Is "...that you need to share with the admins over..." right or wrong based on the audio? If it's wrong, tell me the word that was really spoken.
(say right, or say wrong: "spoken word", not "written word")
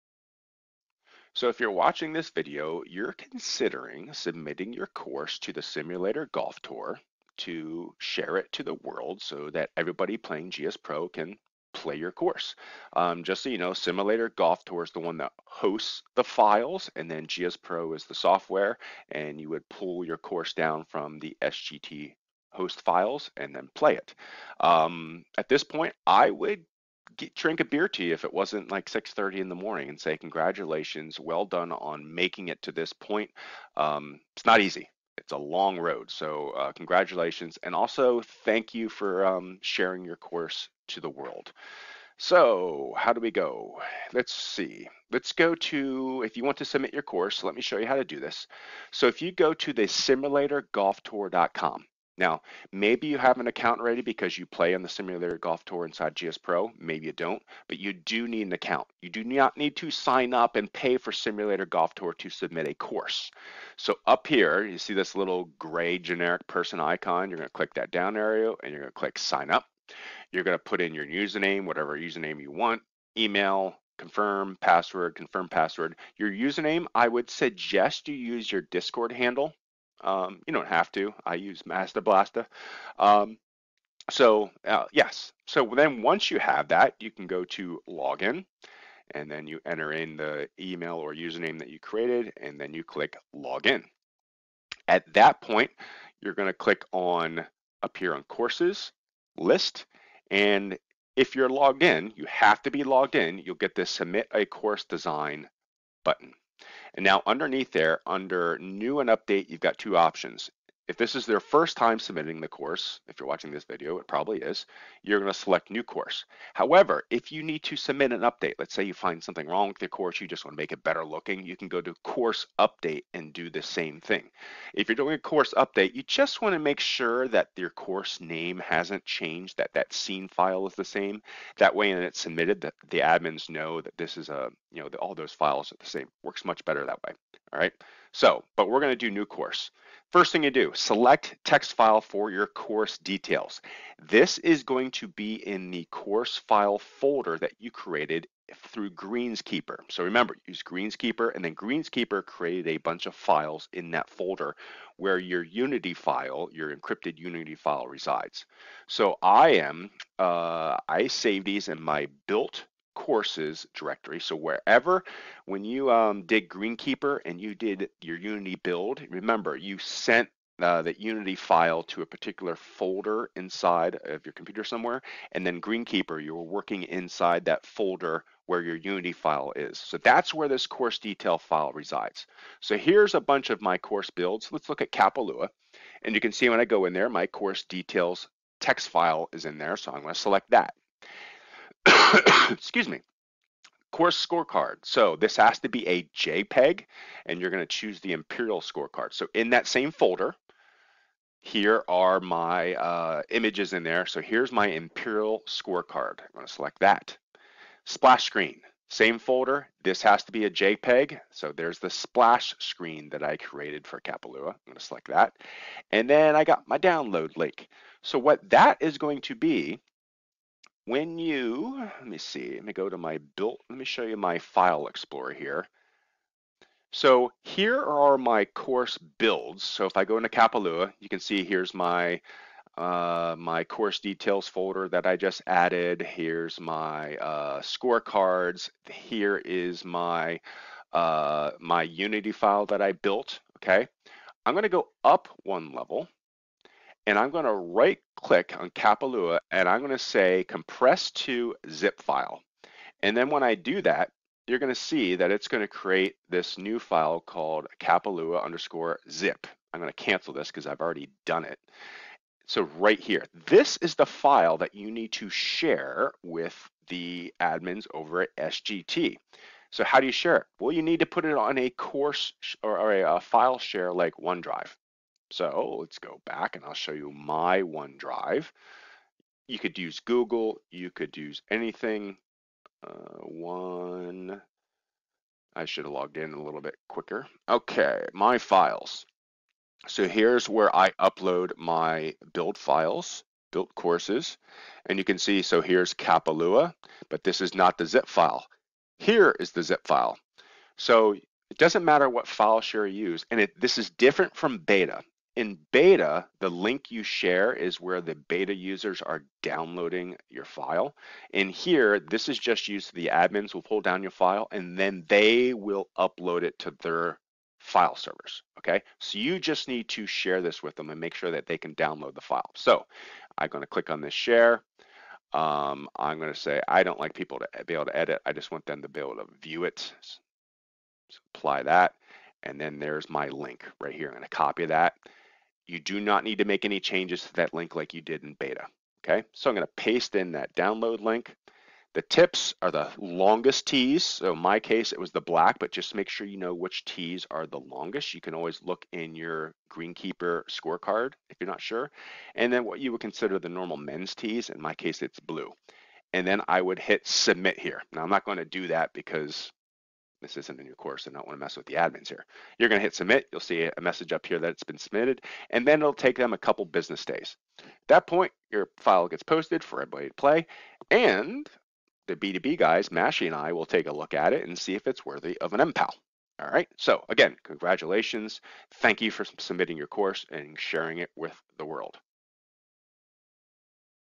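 right.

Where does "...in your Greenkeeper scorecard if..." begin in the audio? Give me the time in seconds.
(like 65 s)
348 s.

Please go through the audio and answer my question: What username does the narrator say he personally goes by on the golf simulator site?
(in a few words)
Master Blaster.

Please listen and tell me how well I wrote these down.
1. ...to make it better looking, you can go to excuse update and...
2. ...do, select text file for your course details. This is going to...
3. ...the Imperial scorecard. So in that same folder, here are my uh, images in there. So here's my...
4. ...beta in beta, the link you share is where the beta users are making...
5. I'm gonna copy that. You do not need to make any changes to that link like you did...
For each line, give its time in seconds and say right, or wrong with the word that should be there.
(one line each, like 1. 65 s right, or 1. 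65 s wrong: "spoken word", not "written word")
1. 120 s wrong: "course", not "excuse"
2. 140 s right
3. 197 s right
4. 304 s wrong: "downloading", not "making"
5. 334 s right.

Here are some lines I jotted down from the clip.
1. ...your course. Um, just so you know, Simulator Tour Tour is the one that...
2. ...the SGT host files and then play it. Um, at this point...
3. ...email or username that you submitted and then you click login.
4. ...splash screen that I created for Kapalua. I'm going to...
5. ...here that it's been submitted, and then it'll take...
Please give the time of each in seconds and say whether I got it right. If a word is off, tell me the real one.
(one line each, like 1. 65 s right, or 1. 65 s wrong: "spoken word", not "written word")
1. 11 s wrong: "Golf", not "Tour"
2. 21 s right
3. 90 s wrong: "created", not "submitted"
4. 211 s right
5. 364 s right.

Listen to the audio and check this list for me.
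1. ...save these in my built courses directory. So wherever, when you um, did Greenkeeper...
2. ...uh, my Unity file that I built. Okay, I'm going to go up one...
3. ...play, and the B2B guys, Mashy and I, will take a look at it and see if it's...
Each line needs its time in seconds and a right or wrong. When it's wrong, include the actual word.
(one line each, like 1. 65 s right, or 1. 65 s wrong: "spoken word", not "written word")
1. 161 s right
2. 240 s right
3. 370 s right.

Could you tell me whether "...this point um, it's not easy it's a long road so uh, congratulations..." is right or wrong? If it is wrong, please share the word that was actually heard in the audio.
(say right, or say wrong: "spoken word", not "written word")
right.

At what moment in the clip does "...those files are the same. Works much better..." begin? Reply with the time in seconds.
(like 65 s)
135 s.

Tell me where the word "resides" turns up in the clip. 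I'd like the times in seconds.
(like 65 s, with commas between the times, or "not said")
157 s, 181 s.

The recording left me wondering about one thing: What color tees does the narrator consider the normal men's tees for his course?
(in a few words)
Blue.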